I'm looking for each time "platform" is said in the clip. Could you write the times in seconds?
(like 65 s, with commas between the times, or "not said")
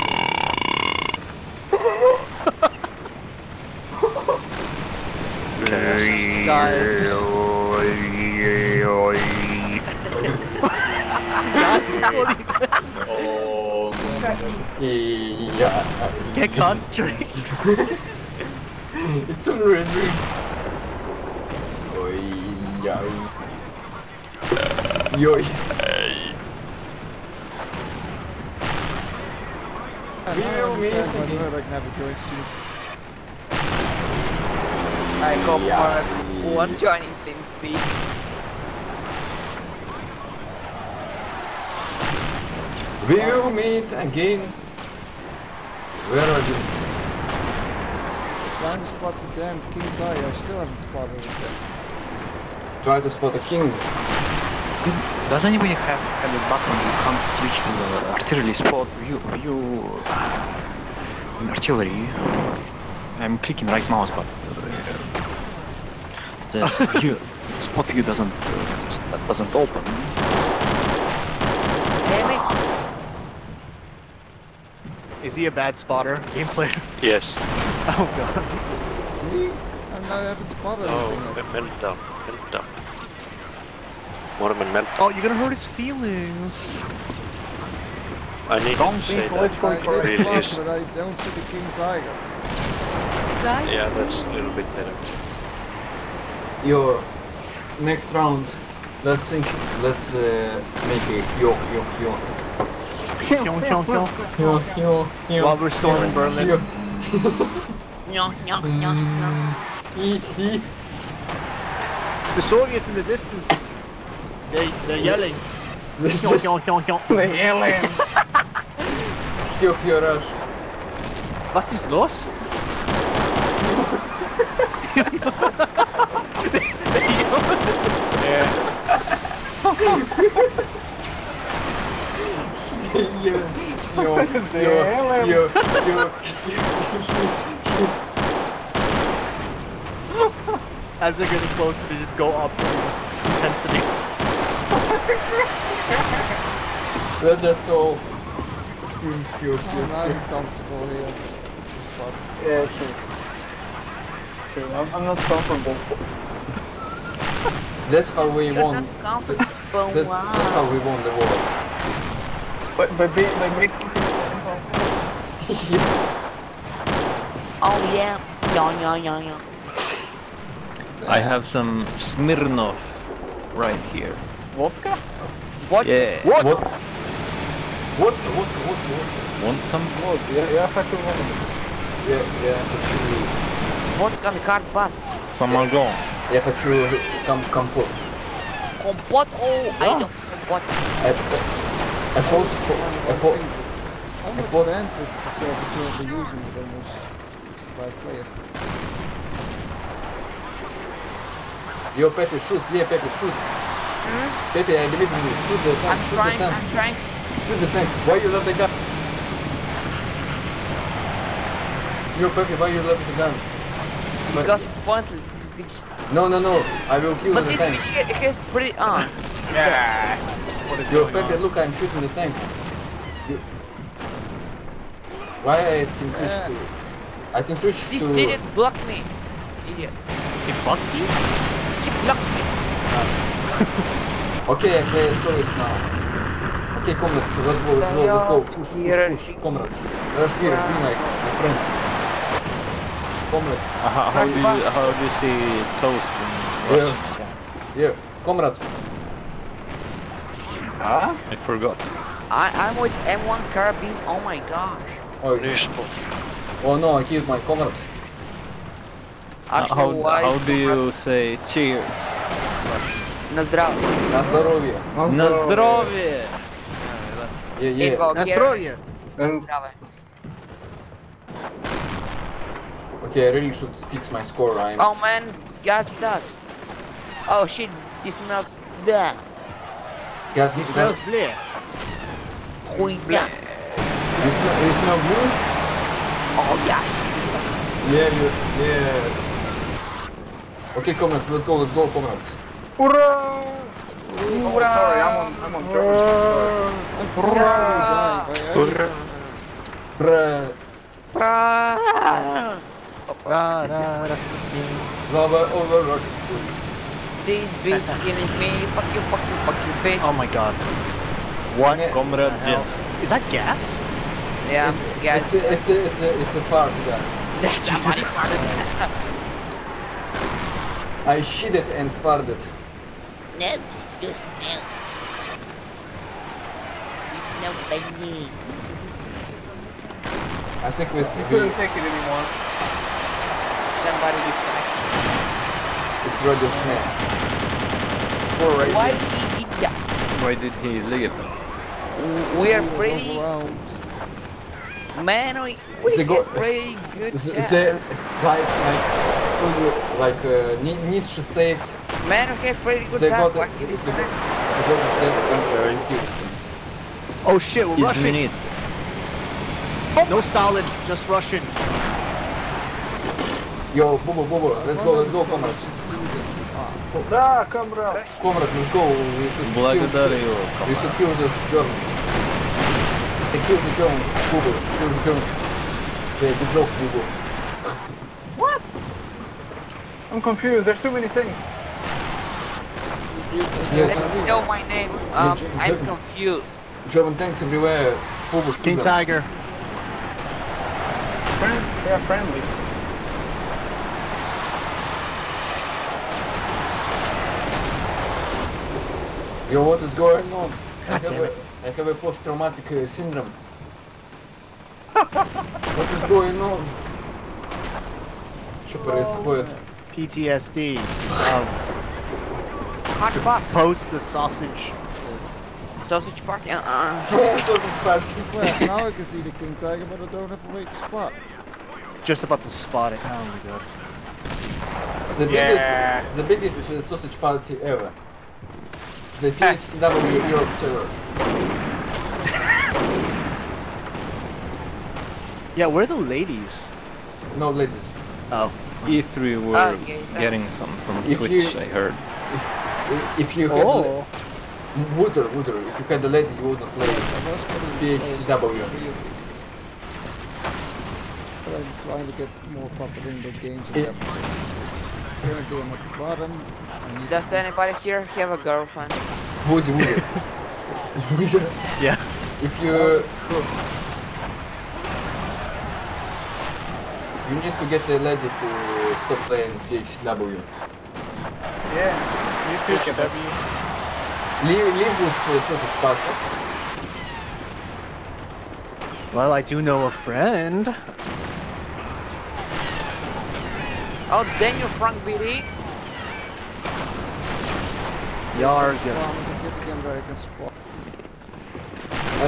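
not said.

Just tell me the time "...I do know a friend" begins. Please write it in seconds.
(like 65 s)
479 s.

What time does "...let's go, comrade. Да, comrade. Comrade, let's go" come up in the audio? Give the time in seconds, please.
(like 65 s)
364 s.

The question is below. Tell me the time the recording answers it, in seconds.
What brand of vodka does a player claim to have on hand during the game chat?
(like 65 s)
171 s.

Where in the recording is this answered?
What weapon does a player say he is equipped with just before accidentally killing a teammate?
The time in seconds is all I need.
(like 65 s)
253 s.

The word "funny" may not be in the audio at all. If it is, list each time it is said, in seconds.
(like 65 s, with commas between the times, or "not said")
327 s.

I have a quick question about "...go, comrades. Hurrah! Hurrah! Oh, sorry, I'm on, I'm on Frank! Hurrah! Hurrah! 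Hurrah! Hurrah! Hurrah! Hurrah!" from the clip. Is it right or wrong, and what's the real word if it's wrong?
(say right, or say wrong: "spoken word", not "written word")
wrong: "Hurrah", not "Frank".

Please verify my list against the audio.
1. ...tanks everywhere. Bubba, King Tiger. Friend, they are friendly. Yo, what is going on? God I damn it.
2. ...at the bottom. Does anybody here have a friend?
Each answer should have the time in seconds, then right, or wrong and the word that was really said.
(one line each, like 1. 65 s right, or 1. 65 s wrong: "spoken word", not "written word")
1. 387 s right
2. 455 s wrong: "girlfriend", not "friend".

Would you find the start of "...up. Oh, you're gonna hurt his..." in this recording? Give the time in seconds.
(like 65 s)
82 s.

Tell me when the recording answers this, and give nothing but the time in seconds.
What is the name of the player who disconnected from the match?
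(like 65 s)
336 s.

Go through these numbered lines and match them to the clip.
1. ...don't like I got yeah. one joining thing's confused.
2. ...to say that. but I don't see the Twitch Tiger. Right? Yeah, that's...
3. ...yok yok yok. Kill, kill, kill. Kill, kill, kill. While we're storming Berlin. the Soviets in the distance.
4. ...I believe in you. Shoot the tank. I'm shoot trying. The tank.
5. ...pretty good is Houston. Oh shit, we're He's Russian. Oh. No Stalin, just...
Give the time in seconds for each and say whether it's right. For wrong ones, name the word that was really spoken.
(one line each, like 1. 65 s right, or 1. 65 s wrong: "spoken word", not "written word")
1. 30 s wrong: "speed", not "confused"
2. 88 s wrong: "King", not "Twitch"
3. 101 s right
4. 204 s right
5. 352 s right.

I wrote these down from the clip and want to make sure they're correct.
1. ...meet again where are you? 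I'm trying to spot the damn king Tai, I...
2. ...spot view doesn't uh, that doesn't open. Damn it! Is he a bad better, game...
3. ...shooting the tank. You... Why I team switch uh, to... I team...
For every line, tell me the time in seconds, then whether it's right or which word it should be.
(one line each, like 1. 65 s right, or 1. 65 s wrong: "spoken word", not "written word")
1. 43 s right
2. 67 s wrong: "spotter", not "better"
3. 221 s right.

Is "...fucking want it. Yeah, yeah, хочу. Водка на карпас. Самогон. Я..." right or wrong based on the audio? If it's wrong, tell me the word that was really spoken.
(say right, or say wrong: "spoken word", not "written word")
right.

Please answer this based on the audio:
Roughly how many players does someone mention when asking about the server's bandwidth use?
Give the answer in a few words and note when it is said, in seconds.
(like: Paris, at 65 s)
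65, at 197 s.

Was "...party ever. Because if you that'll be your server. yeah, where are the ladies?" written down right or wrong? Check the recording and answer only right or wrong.
wrong.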